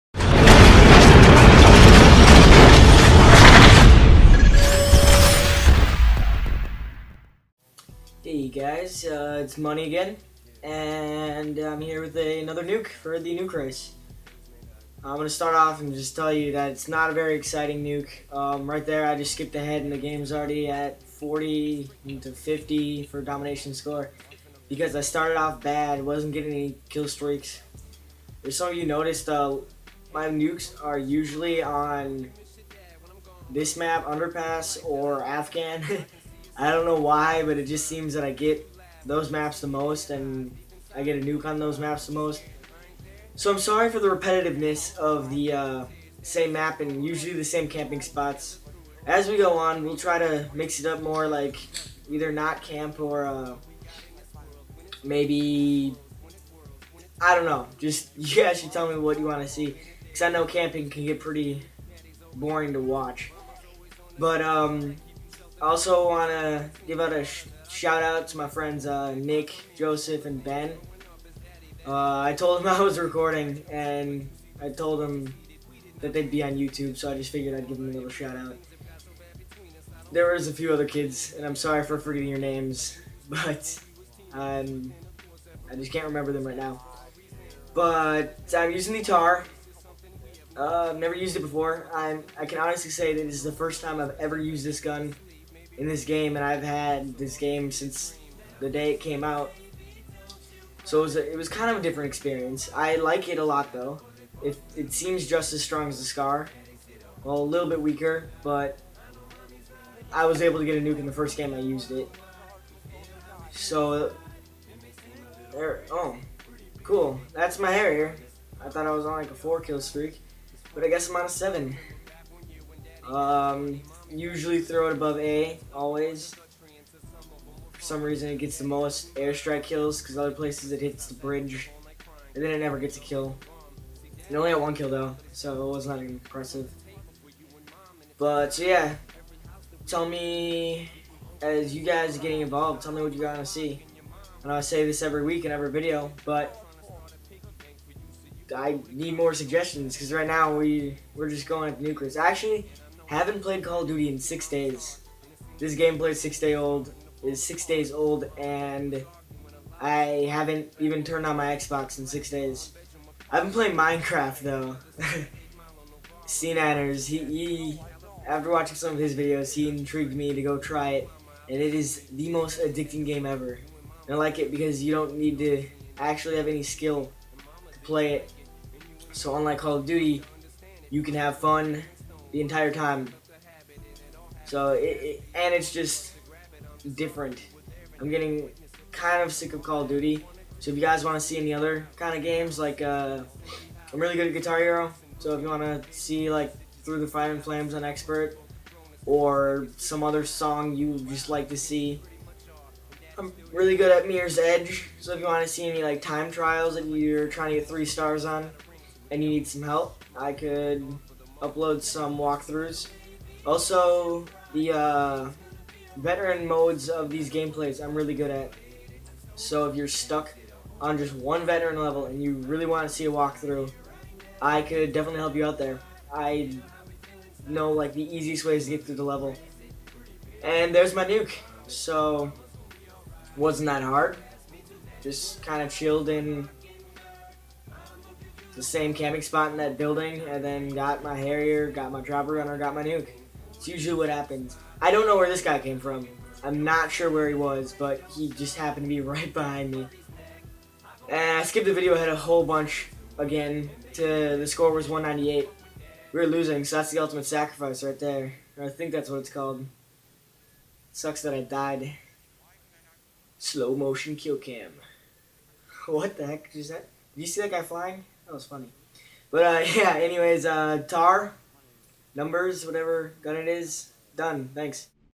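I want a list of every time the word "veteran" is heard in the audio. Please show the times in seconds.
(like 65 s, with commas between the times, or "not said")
215 s, 221 s.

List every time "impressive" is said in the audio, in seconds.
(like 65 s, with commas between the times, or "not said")
135 s.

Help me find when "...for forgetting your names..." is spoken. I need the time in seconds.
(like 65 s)
81 s.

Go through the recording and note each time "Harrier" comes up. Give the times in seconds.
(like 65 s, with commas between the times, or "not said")
117 s, 241 s.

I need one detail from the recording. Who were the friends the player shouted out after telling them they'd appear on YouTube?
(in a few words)
Nick, Joseph, and Ben.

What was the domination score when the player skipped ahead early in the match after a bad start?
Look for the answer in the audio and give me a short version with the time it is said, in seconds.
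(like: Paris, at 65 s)
40 to 50, at 21 s.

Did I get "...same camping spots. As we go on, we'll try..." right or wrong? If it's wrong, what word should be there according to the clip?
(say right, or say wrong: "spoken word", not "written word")
right.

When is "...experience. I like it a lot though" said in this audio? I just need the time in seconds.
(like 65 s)
102 s.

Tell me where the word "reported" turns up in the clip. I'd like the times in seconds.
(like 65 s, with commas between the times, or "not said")
not said.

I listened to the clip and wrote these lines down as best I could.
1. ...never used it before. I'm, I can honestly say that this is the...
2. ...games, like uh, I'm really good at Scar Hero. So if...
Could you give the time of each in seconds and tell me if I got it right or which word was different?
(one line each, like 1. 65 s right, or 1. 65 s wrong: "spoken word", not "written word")
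1. 90 s right
2. 192 s wrong: "Guitar", not "Scar".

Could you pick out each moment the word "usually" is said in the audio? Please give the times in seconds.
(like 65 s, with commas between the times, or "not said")
30 s, 47 s, 124 s, 243 s.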